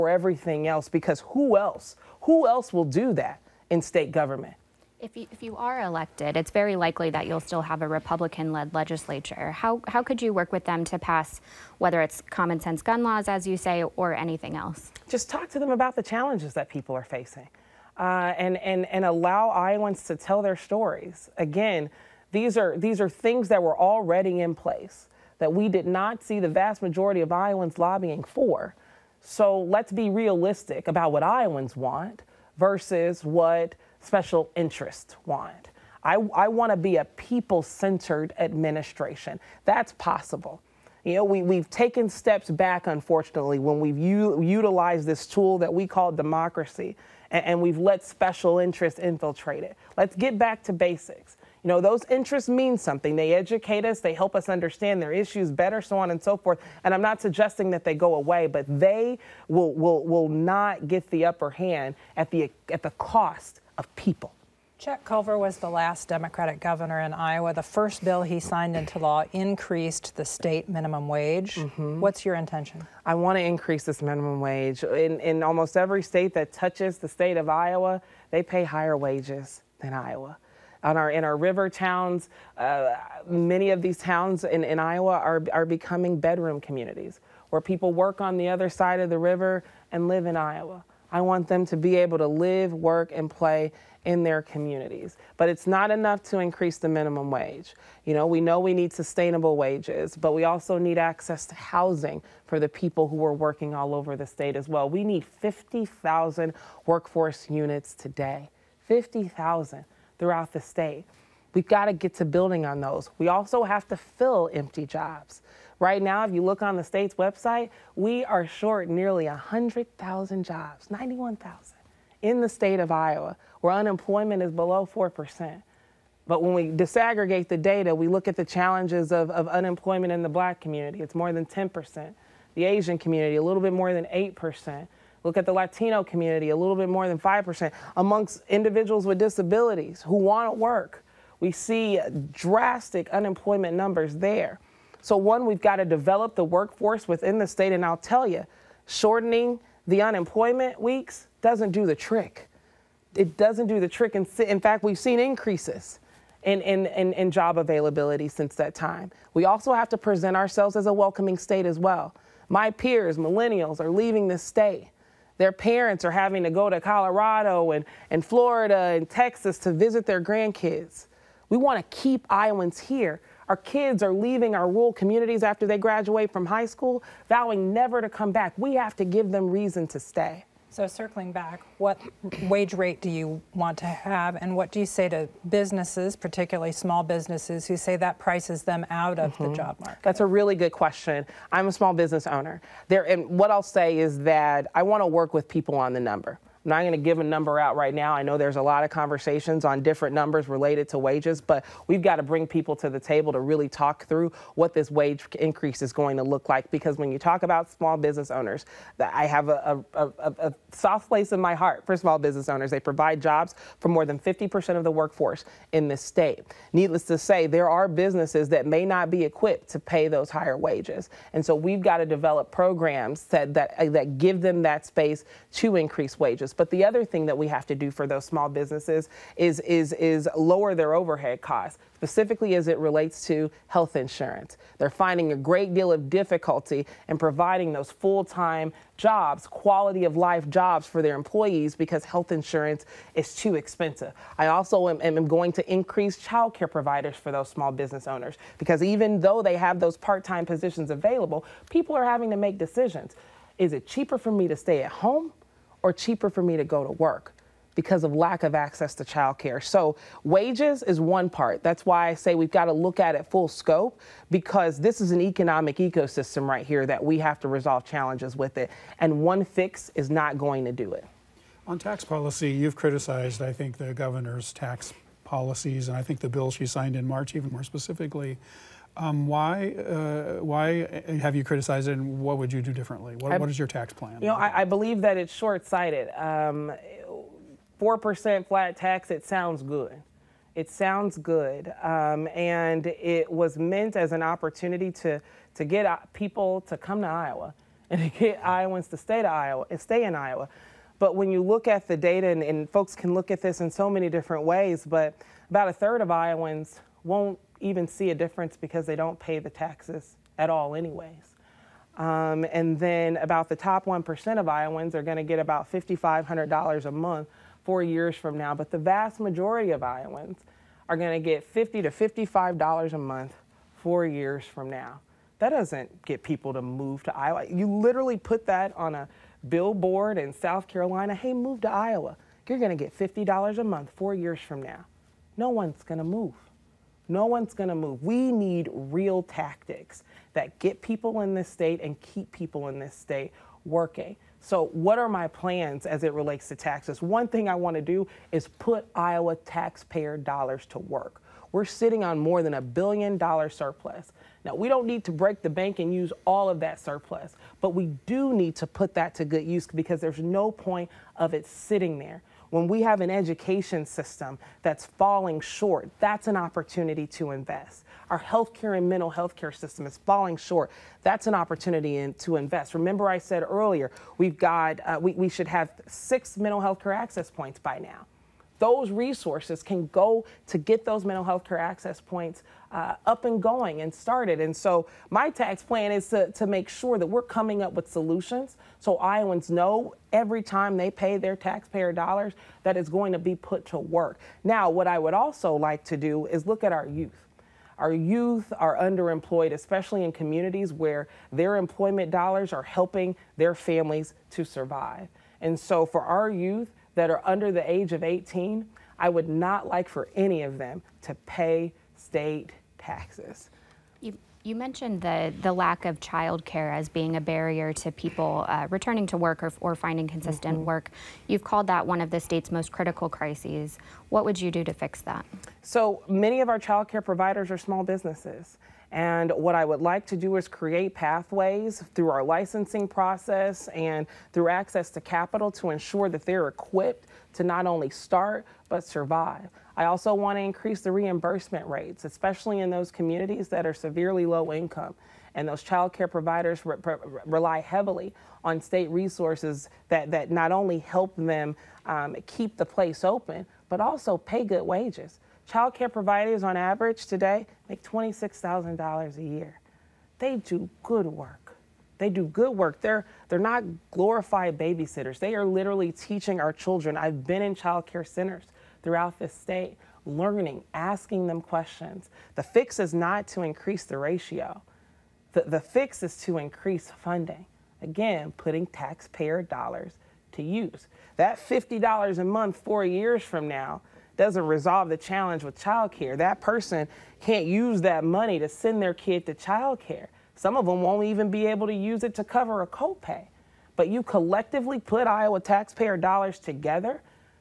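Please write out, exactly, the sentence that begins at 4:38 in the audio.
Um, why, uh, why have you criticized it, and what would you do differently?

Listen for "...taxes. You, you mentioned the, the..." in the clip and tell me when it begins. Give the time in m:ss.
6:52.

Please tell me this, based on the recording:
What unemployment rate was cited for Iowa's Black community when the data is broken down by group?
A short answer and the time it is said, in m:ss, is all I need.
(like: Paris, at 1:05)
More than 10%, at 2:11.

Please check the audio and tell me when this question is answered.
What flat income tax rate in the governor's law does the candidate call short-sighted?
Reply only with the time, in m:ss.
4:47.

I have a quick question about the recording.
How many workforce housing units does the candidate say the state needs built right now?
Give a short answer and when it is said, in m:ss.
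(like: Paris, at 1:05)
50,000, at 1:45.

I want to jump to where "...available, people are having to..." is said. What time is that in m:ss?
4:10.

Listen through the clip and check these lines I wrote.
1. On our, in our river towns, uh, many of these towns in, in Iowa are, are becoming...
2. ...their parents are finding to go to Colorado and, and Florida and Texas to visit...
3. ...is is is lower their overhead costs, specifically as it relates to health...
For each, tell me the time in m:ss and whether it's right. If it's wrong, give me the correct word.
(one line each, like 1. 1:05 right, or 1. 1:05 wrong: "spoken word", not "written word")
1. 1:20 right
2. 2:45 wrong: "having", not "finding"
3. 3:49 right.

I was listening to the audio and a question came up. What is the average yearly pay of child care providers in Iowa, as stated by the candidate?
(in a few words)
$26,000.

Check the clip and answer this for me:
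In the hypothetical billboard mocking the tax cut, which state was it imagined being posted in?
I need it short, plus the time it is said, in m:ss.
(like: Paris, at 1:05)
South Carolina, at 5:30.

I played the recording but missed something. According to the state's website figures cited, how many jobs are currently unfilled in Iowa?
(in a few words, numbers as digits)
91,000.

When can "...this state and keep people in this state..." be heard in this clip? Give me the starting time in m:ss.
5:41.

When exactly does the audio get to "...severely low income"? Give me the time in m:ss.
7:23.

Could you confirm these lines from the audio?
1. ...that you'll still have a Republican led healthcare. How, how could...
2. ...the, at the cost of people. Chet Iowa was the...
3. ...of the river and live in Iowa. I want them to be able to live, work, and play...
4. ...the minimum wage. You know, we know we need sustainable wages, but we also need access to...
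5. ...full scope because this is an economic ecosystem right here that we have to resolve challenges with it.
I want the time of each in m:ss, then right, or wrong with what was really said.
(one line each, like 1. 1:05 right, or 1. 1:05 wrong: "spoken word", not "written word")
1. 0:07 wrong: "legislature", not "healthcare"
2. 1:02 wrong: "Culver", not "Iowa"
3. 1:29 right
4. 1:36 right
5. 4:23 right.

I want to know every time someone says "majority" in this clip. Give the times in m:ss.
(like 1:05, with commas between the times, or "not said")
0:26, 5:19.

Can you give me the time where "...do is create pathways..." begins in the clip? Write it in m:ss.
7:10.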